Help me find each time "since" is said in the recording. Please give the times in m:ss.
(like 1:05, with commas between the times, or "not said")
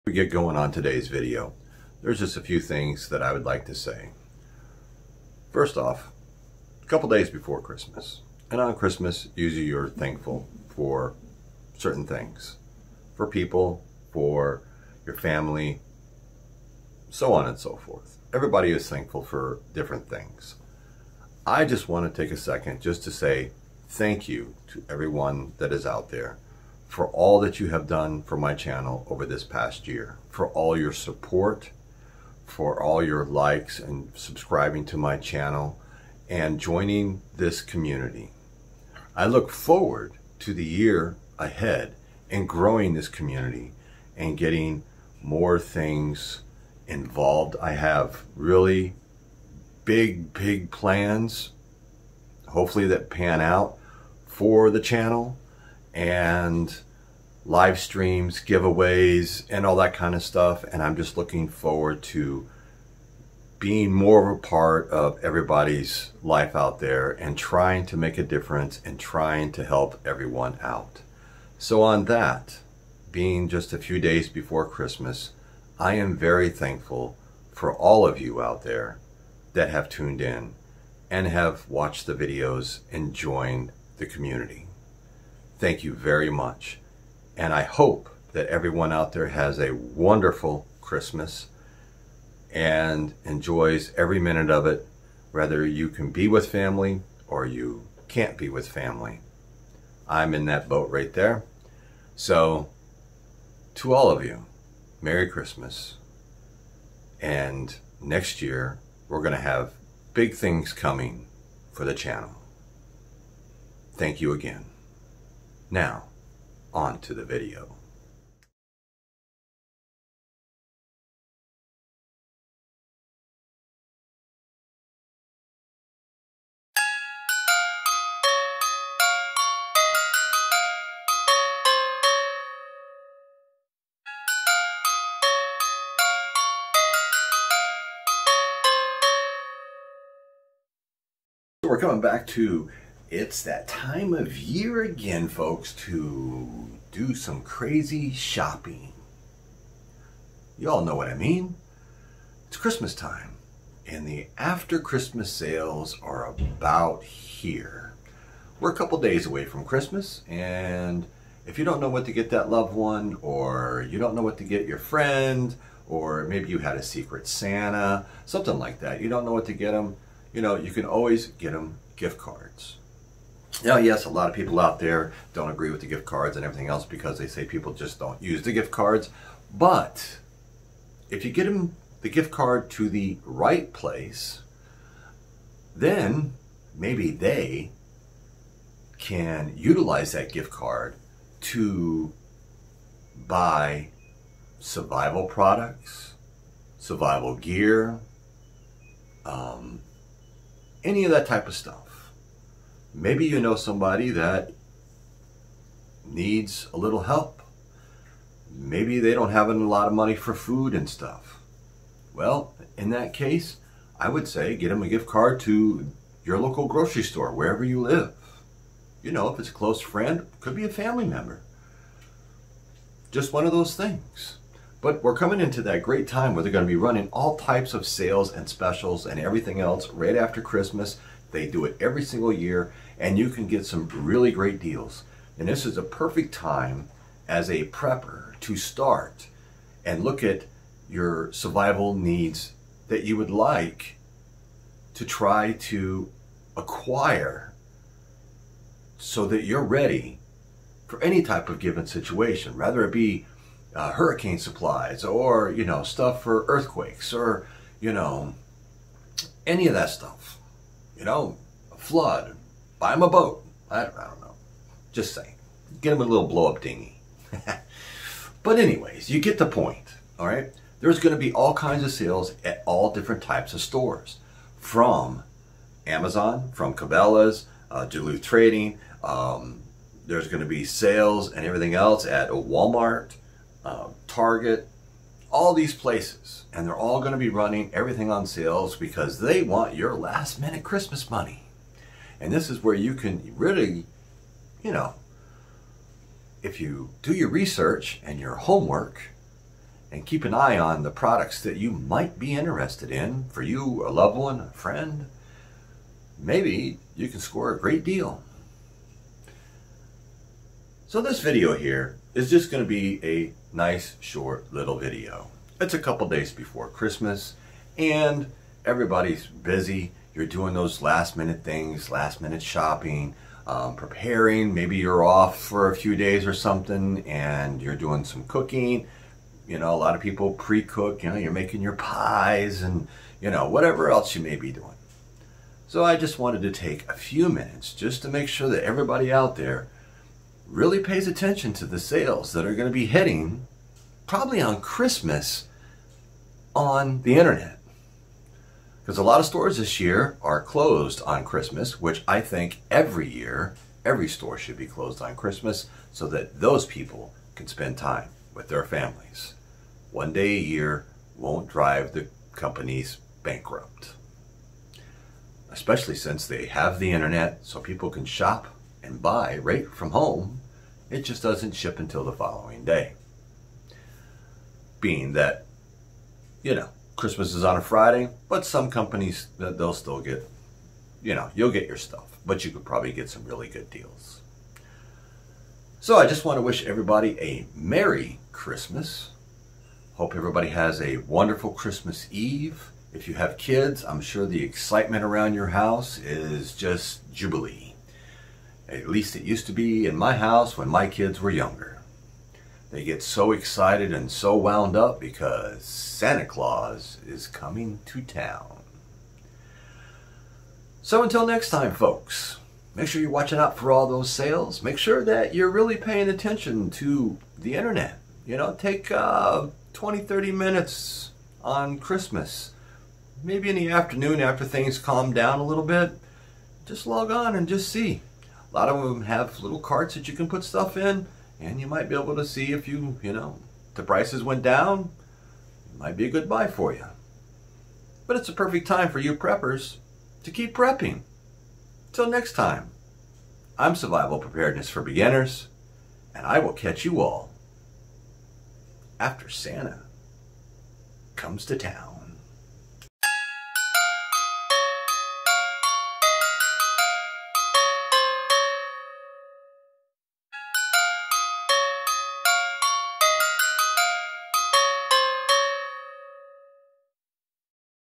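6:05.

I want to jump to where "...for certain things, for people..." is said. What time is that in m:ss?
0:10.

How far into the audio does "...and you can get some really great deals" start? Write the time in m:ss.
3:52.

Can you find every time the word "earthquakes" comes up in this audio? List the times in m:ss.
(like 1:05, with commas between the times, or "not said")
4:16.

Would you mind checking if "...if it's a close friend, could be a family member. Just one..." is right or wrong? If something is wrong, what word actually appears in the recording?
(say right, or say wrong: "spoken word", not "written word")
right.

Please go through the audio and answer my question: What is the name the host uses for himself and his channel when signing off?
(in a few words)
Survival Preparedness for Beginners.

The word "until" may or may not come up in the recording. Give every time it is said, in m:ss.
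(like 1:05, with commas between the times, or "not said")
6:11, 6:51.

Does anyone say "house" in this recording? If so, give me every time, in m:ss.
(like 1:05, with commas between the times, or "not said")
6:35, 6:40.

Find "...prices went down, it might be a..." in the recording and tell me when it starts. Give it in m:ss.
7:13.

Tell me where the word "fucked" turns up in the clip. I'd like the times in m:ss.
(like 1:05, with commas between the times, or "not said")
not said.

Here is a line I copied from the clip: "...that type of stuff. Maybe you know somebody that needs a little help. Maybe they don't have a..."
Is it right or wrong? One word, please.
right.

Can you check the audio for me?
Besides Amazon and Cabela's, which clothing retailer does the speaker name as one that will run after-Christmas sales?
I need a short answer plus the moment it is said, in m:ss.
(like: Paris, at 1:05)
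Duluth Trading, at 4:37.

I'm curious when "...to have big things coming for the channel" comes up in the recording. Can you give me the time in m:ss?
1:49.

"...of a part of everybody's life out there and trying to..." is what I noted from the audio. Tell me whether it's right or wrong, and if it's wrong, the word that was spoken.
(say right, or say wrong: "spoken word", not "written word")
right.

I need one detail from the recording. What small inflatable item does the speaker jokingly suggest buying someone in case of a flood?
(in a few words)
blow up dinghy.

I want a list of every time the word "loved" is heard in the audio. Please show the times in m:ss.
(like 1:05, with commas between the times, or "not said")
2:42, 5:03.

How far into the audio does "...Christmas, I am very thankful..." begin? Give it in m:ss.
1:14.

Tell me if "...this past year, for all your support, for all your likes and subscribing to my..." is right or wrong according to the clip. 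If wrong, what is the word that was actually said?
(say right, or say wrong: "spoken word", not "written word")
right.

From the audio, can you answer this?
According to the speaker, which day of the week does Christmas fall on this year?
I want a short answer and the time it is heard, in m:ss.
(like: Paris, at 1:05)
Friday, at 6:17.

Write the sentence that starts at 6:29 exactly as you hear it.
Hope everybody has a wonderful Christmas Eve.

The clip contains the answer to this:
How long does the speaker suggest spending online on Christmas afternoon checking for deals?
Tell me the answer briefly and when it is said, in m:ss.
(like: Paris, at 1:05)
20 to 30 minutes, at 6:59.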